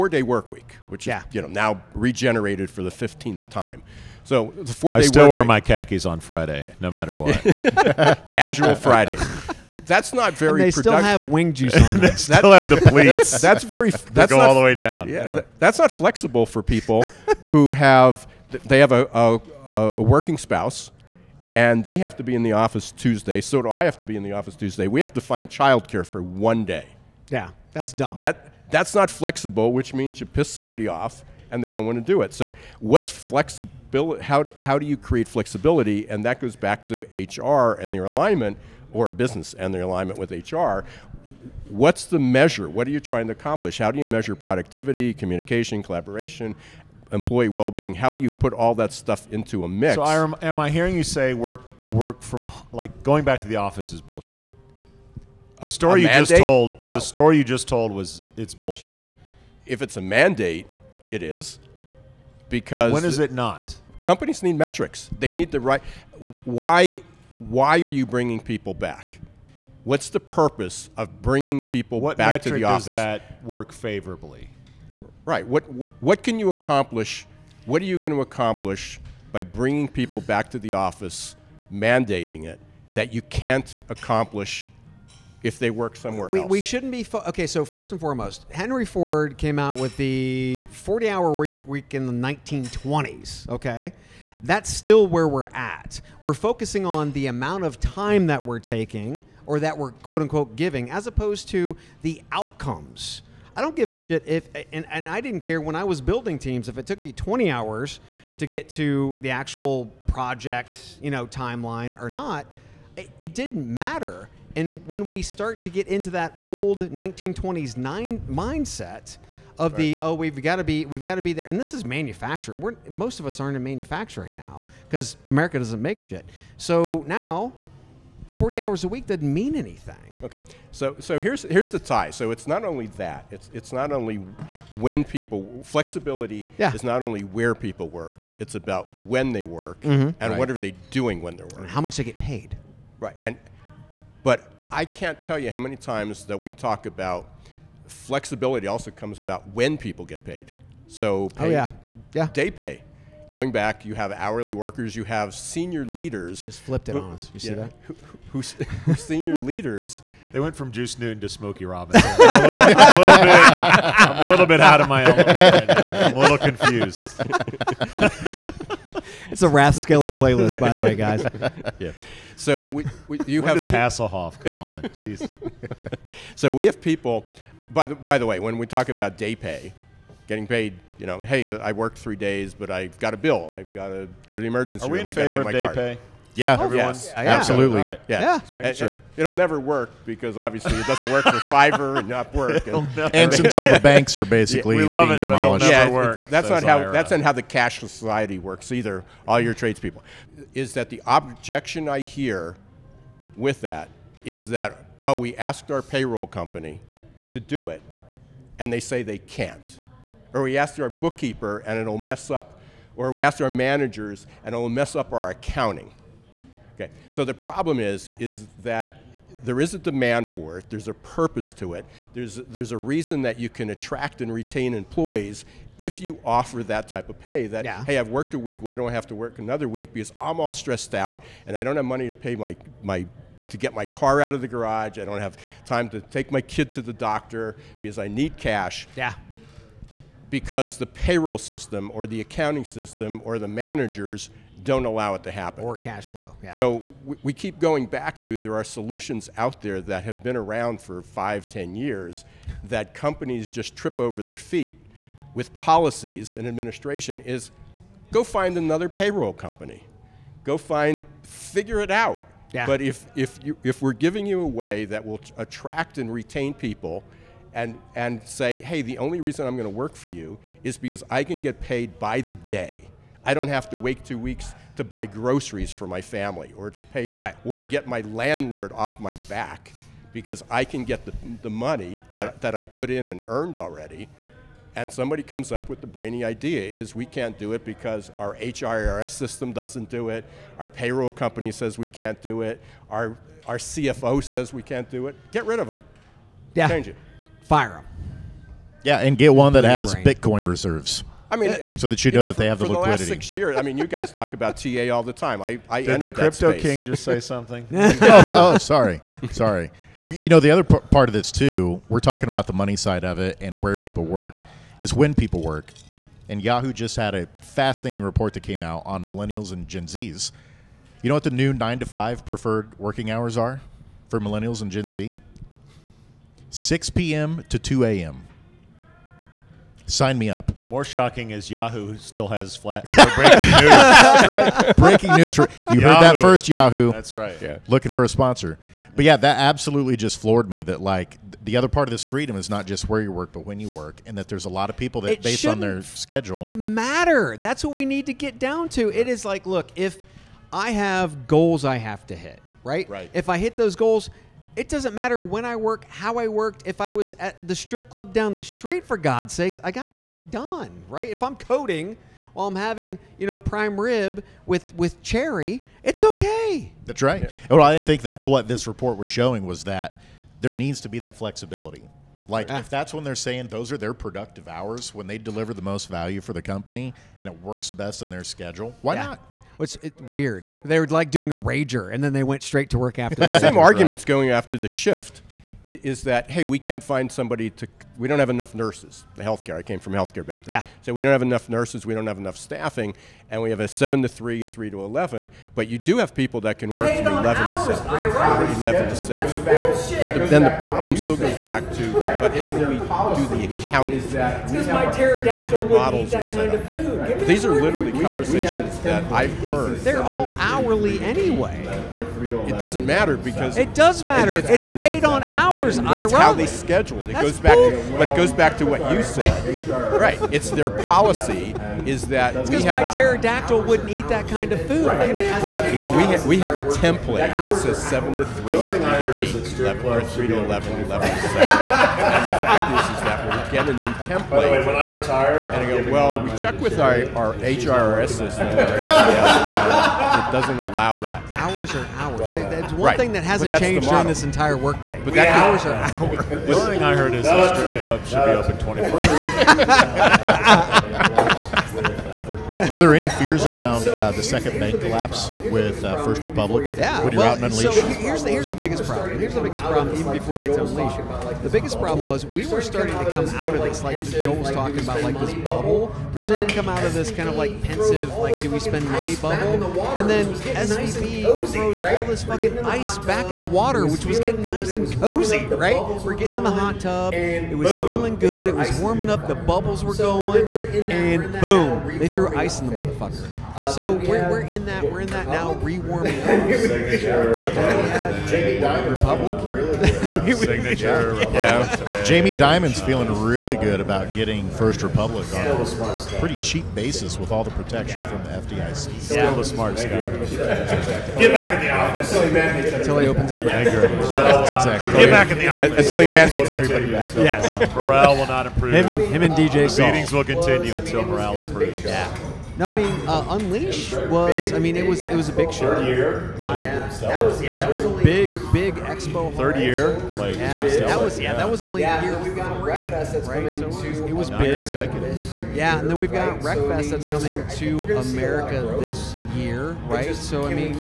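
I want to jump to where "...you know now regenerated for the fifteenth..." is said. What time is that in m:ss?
0:01.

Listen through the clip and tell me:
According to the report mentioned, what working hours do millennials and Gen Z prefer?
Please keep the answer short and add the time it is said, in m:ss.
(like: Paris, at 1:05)
6 p.m. to 2 a.m., at 5:26.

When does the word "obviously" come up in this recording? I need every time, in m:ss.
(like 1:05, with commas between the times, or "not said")
3:10.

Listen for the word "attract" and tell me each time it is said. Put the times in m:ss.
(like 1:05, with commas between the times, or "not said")
3:43, 4:25.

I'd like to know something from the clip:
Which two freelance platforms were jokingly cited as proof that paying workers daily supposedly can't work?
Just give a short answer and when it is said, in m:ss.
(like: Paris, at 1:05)
Fiverr and Upwork, at 3:11.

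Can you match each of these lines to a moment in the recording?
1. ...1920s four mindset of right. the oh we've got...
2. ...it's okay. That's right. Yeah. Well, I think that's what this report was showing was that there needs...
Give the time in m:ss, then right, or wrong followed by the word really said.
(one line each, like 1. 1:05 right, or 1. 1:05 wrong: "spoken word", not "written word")
1. 1:56 wrong: "nine", not "four"
2. 6:05 right.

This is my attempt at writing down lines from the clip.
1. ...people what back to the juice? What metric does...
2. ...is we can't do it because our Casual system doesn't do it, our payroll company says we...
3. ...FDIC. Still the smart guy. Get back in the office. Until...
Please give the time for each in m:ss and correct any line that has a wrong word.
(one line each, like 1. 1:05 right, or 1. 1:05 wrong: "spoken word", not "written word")
1. 1:11 wrong: "office", not "juice"
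2. 4:46 wrong: "HRIS", not "Casual"
3. 8:18 right.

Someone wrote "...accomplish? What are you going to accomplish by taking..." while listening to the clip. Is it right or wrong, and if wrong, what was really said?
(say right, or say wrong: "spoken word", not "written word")
wrong: "bringing", not "taking".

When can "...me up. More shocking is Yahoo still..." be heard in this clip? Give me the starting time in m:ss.
5:30.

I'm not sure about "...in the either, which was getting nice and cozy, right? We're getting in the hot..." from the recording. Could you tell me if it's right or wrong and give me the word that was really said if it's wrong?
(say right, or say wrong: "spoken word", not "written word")
wrong: "water", not "either".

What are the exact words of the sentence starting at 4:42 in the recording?
that, that I put in and earned already.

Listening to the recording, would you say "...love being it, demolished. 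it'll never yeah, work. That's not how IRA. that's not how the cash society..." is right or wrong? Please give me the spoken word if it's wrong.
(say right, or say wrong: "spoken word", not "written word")
right.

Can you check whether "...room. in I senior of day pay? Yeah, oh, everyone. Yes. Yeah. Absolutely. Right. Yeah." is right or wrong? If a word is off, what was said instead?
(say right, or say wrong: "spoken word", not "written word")
wrong: "favor", not "senior".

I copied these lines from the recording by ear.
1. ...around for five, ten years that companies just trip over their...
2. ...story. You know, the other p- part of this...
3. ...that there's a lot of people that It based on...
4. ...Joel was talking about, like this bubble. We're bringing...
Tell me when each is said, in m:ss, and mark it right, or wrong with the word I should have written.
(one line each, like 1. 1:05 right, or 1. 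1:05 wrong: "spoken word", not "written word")
1. 4:10 right
2. 5:09 wrong: "sorry", not "story"
3. 5:44 right
4. 7:44 wrong: "starting", not "bringing".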